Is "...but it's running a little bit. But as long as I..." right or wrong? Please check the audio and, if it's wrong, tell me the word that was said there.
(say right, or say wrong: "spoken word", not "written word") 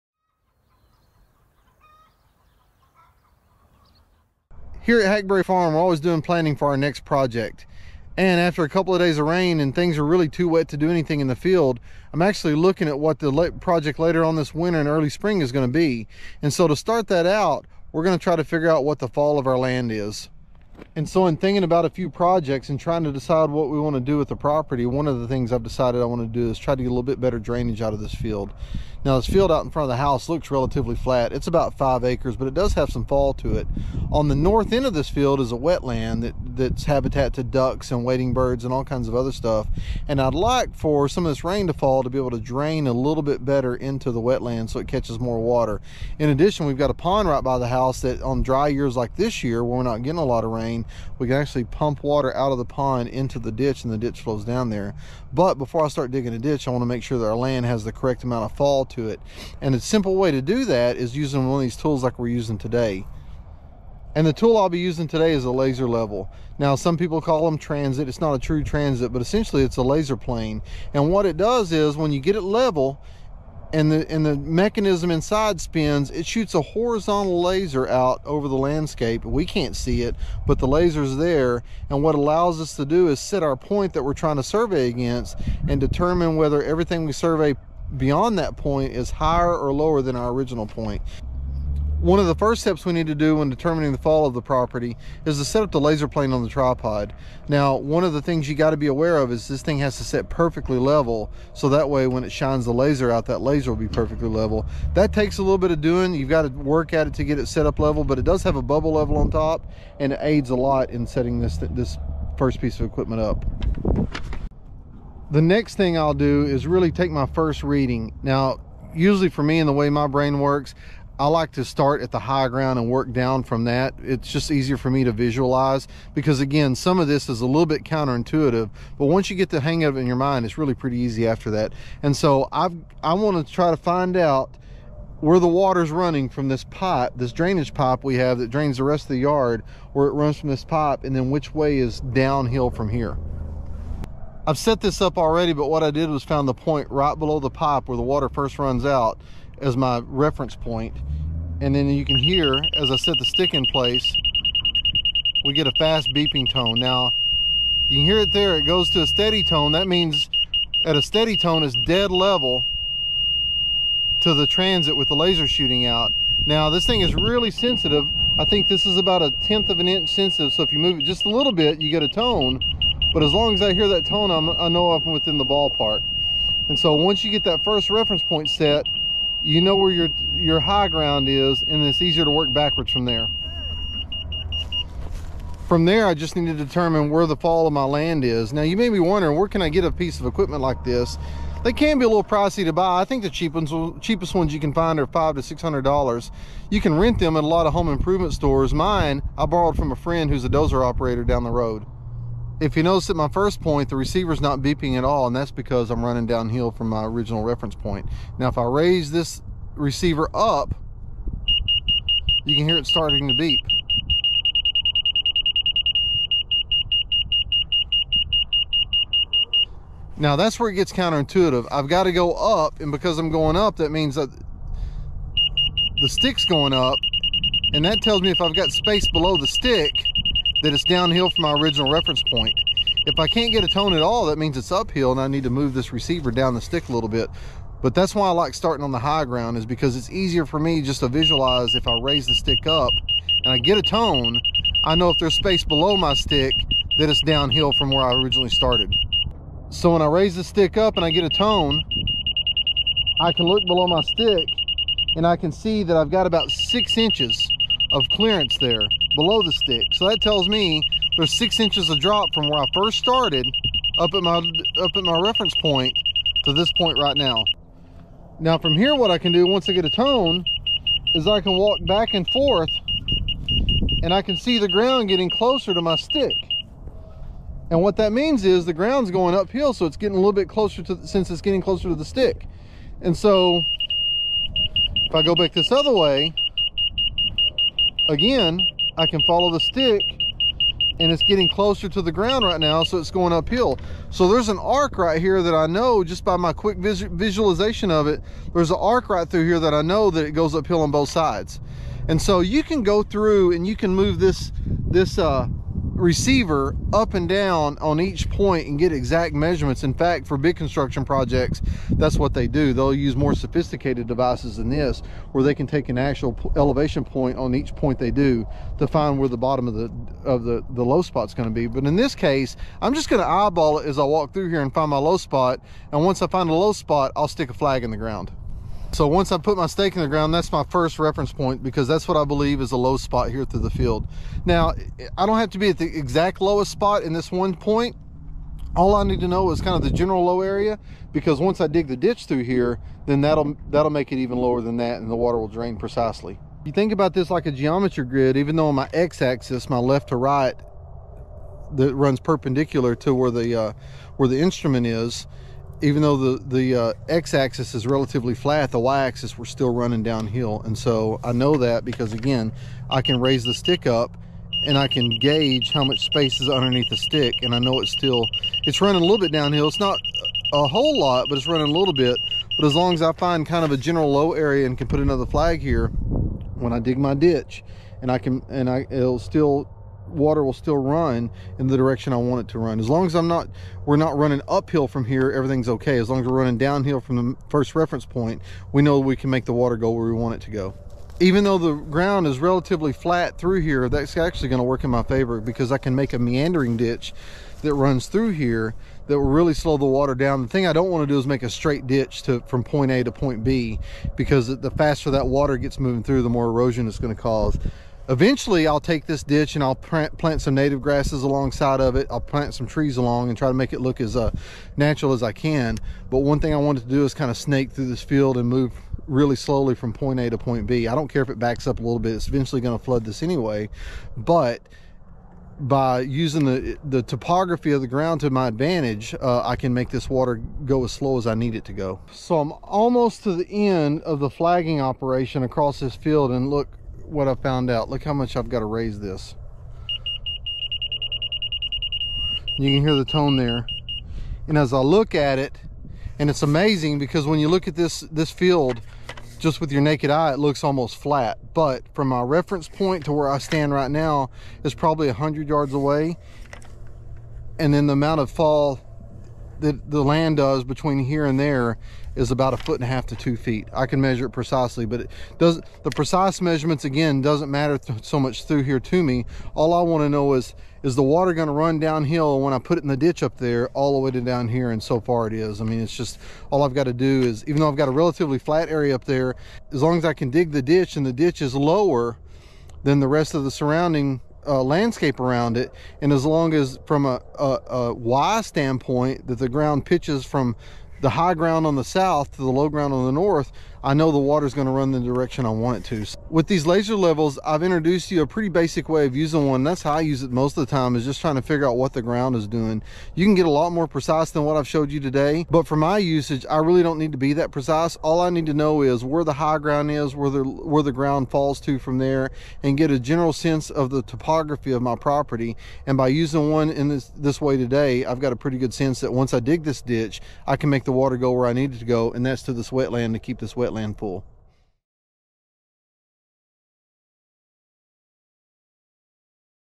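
right.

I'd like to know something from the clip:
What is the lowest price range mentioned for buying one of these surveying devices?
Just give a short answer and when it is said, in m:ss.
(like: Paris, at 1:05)
$500 to $600, at 3:15.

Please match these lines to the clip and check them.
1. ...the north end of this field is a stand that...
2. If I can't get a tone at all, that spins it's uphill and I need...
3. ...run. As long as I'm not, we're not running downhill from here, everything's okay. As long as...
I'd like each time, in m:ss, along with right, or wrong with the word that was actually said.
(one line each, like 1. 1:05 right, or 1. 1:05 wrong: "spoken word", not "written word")
1. 0:34 wrong: "wetland", not "stand"
2. 3:53 wrong: "means", not "spins"
3. 6:22 wrong: "uphill", not "downhill".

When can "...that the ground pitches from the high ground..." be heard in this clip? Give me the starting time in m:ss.
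8:09.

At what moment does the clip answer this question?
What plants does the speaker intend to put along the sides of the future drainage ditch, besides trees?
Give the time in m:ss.
6:50.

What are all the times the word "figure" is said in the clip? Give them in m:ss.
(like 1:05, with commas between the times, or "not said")
0:18, 8:21.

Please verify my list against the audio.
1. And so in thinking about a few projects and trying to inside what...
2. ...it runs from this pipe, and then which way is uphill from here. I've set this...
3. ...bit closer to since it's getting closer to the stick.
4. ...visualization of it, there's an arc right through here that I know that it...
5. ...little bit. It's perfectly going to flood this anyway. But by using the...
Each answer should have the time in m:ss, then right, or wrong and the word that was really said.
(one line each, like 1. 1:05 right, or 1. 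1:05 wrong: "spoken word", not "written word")
1. 0:20 wrong: "decide", not "inside"
2. 2:20 wrong: "downhill", not "uphill"
3. 4:40 right
4. 4:57 right
5. 7:01 wrong: "eventually", not "perfectly".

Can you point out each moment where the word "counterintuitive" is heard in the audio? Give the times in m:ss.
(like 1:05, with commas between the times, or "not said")
2:07, 3:40.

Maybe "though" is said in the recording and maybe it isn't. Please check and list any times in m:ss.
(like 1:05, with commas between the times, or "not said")
5:48, 5:56, 6:31, 7:57.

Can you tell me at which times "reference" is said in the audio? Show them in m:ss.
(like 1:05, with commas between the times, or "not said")
2:30, 2:57, 3:27, 3:51, 4:25, 5:30, 6:27, 7:32.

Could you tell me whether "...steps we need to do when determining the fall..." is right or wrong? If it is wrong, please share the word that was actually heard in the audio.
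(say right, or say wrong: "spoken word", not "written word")
right.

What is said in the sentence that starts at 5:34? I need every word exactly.
Now, I don't have to be at the exact lowest spot in this one point.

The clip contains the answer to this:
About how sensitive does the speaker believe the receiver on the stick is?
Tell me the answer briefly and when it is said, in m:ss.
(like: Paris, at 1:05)
A tenth of an inch, at 2:49.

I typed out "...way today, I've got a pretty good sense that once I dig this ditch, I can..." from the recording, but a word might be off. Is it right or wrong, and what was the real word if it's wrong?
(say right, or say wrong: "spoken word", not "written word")
right.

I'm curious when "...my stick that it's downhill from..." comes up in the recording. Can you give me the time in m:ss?
4:05.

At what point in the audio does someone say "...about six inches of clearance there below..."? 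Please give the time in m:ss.
4:16.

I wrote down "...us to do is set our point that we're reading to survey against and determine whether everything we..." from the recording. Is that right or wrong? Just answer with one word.
wrong.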